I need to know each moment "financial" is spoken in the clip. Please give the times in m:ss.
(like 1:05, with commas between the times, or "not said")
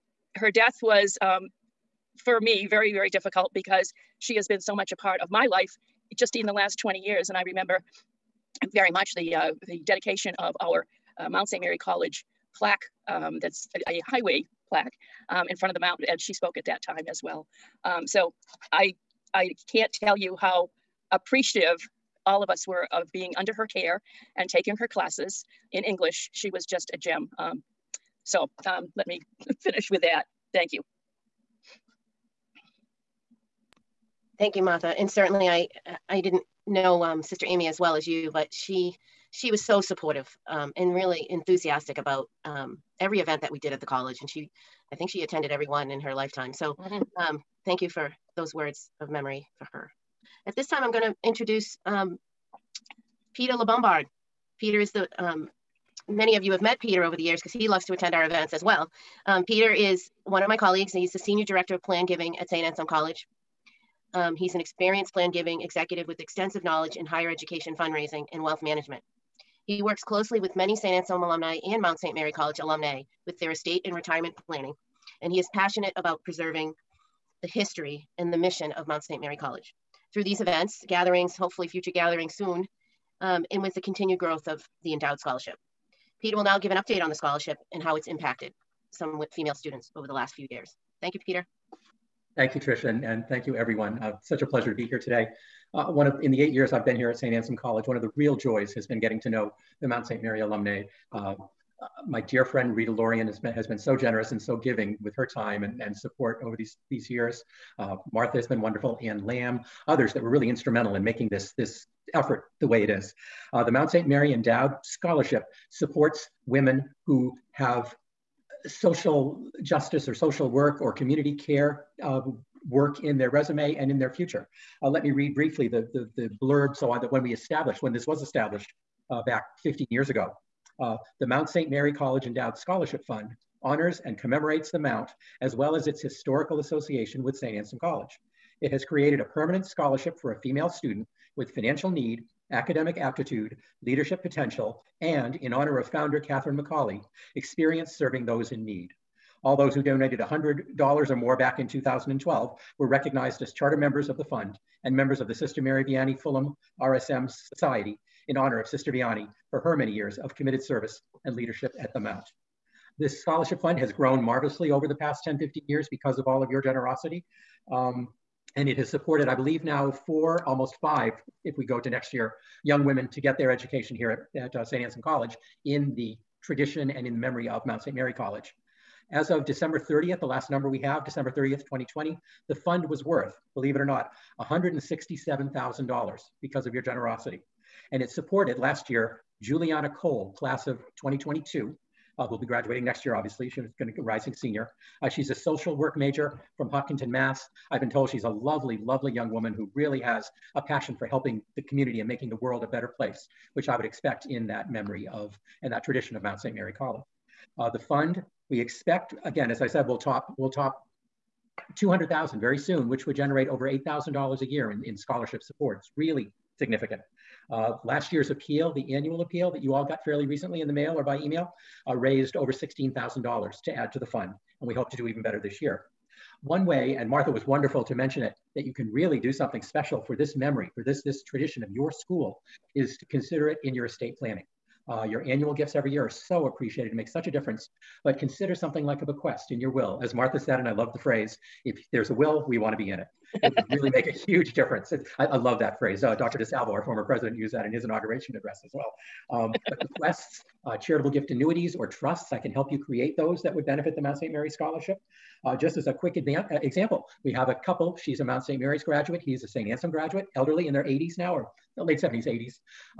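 2:21.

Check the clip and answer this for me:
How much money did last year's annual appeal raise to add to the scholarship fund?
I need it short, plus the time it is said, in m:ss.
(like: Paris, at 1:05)
Over $16,000, at 3:42.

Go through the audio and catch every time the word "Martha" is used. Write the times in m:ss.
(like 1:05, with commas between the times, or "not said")
0:34, 1:48, 3:47, 4:00.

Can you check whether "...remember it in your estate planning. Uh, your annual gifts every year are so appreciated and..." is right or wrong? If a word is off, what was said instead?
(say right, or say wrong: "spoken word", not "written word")
wrong: "consider", not "remember".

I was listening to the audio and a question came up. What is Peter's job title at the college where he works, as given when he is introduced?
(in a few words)
Senior Director of Plan Giving.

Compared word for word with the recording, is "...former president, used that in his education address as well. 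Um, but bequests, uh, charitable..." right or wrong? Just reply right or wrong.
wrong.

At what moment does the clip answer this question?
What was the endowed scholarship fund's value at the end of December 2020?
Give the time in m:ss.
3:04.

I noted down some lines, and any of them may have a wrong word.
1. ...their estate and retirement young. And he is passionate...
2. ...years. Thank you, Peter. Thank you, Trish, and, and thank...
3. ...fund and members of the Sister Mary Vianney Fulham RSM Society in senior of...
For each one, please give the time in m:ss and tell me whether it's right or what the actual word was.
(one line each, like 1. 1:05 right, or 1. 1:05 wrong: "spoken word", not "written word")
1. 1:13 wrong: "planning", not "young"
2. 1:30 right
3. 2:34 wrong: "honor", not "senior".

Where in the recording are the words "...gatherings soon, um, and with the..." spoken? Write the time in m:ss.
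1:21.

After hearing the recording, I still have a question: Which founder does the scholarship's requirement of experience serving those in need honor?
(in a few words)
Catherine McAuley.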